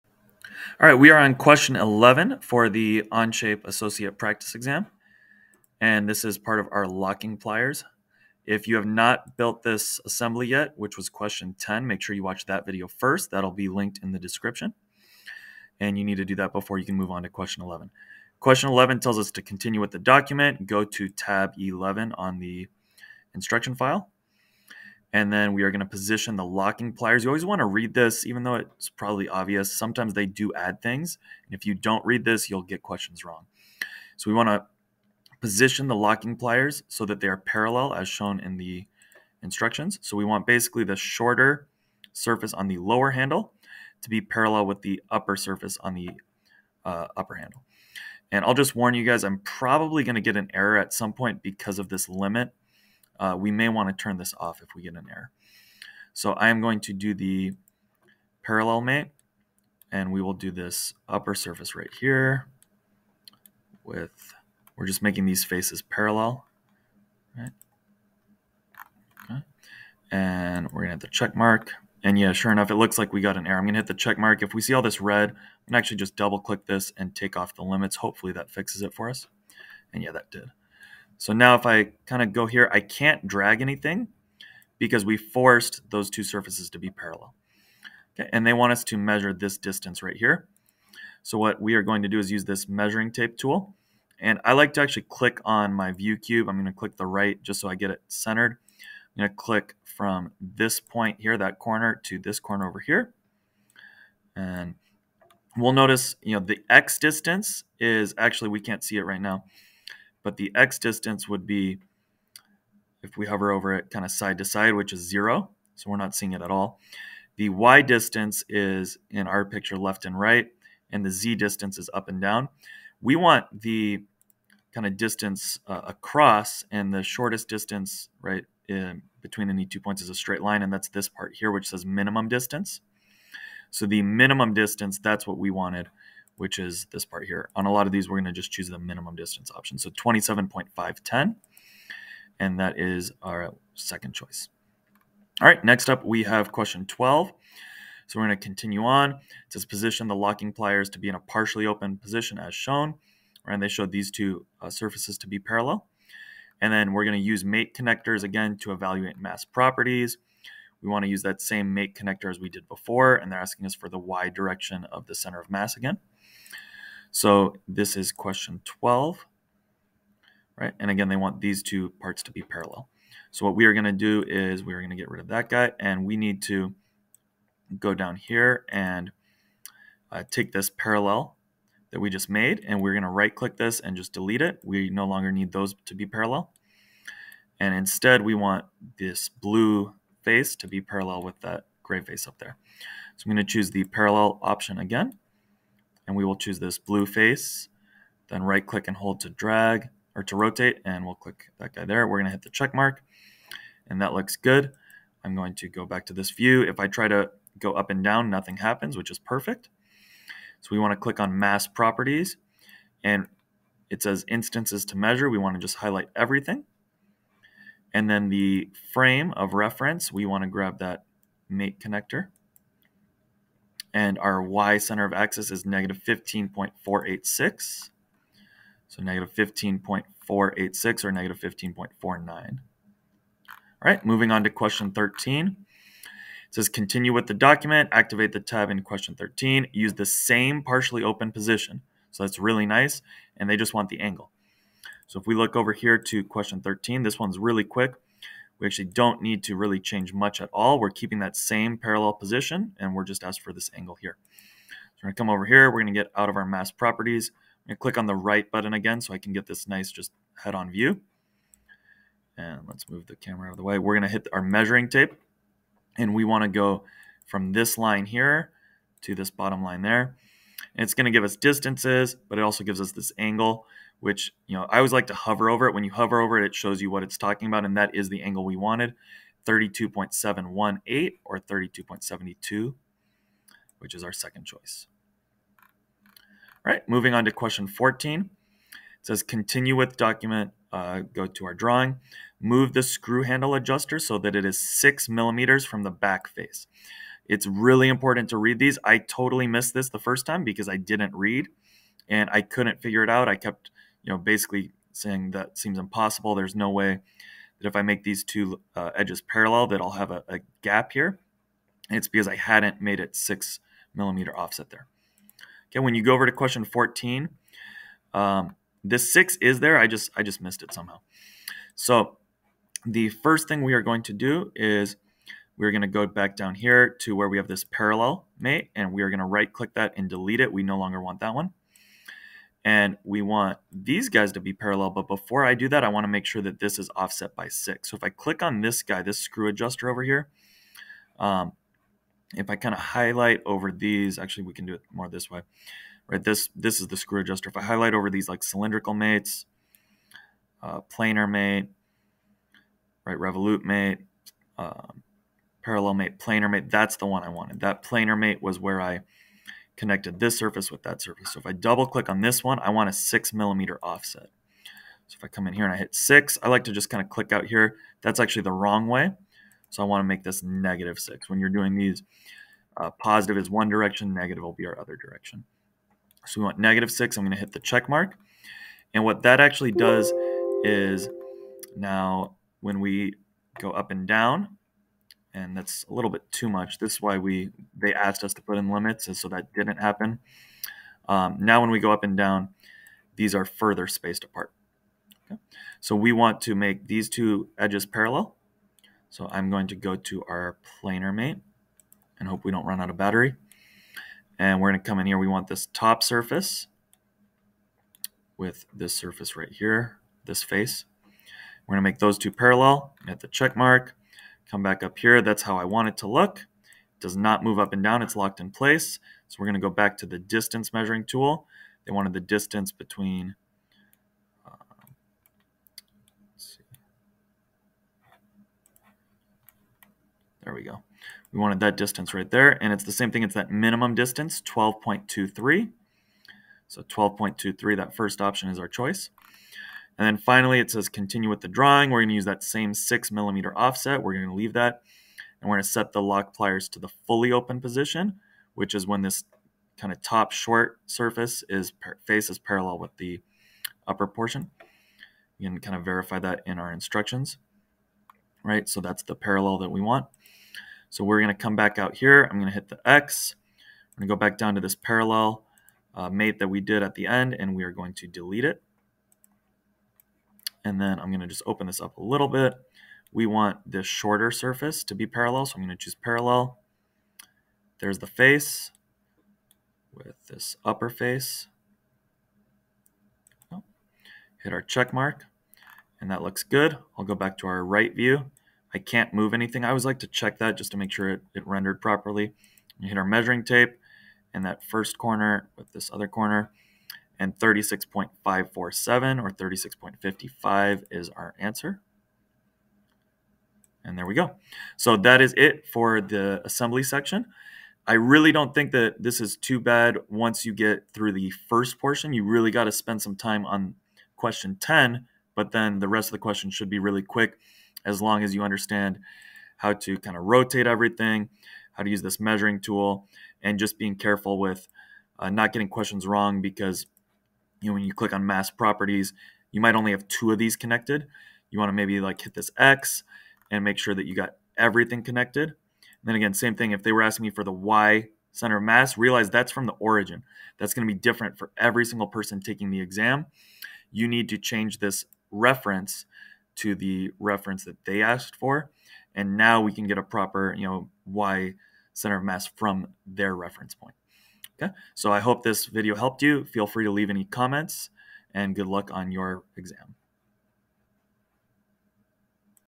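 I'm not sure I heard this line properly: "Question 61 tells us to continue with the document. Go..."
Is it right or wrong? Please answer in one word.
wrong.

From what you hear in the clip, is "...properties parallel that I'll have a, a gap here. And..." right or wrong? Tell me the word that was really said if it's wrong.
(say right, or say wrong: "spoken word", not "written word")
wrong: "edges", not "properties".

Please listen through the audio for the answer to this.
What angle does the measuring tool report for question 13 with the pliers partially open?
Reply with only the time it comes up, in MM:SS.
04:39.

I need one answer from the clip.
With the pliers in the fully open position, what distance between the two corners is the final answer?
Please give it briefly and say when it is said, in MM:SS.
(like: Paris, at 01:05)
36.547, at 08:17.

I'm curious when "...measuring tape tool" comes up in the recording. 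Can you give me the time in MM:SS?
01:32.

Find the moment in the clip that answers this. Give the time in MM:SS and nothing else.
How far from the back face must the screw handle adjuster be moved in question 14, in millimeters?
04:54.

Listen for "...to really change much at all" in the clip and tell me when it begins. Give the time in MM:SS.
04:09.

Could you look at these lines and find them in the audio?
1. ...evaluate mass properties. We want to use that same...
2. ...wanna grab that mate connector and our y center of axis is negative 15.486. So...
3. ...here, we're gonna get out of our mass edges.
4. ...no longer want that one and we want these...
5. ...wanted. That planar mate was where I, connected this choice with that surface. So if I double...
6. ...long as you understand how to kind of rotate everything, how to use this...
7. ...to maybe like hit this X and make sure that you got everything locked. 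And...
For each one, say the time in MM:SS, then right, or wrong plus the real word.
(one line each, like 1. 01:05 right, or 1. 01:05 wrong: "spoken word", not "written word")
1. 02:38 right
2. 03:40 right
3. 04:15 wrong: "properties", not "edges"
4. 05:30 right
5. 05:57 wrong: "surface", not "choice"
6. 08:38 right
7. 08:51 wrong: "connected", not "locked".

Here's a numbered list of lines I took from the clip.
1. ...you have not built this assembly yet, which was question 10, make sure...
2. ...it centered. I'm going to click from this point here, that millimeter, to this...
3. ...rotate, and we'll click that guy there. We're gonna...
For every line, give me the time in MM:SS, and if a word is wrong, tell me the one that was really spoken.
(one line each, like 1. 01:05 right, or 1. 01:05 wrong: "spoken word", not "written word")
1. 00:08 right
2. 01:37 wrong: "corner", not "millimeter"
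3. 03:20 right.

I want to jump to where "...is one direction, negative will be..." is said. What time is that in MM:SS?
06:13.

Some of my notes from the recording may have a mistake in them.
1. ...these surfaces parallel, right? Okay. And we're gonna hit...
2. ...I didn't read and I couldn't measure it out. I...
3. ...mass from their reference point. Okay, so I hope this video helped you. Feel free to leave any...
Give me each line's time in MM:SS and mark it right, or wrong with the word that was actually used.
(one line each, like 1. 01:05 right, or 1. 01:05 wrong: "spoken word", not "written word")
1. 01:05 wrong: "faces", not "surfaces"
2. 05:00 wrong: "figure", not "measure"
3. 09:12 right.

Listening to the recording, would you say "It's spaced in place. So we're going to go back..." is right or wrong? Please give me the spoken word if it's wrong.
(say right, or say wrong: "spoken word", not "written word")
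wrong: "locked", not "spaced".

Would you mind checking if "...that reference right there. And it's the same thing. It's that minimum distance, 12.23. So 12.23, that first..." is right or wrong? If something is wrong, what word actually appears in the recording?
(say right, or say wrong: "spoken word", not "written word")
wrong: "distance", not "reference".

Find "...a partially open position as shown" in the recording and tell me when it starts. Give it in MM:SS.
02:31.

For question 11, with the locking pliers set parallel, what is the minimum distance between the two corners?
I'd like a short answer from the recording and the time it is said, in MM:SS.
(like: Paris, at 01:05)
27.510, at 02:19.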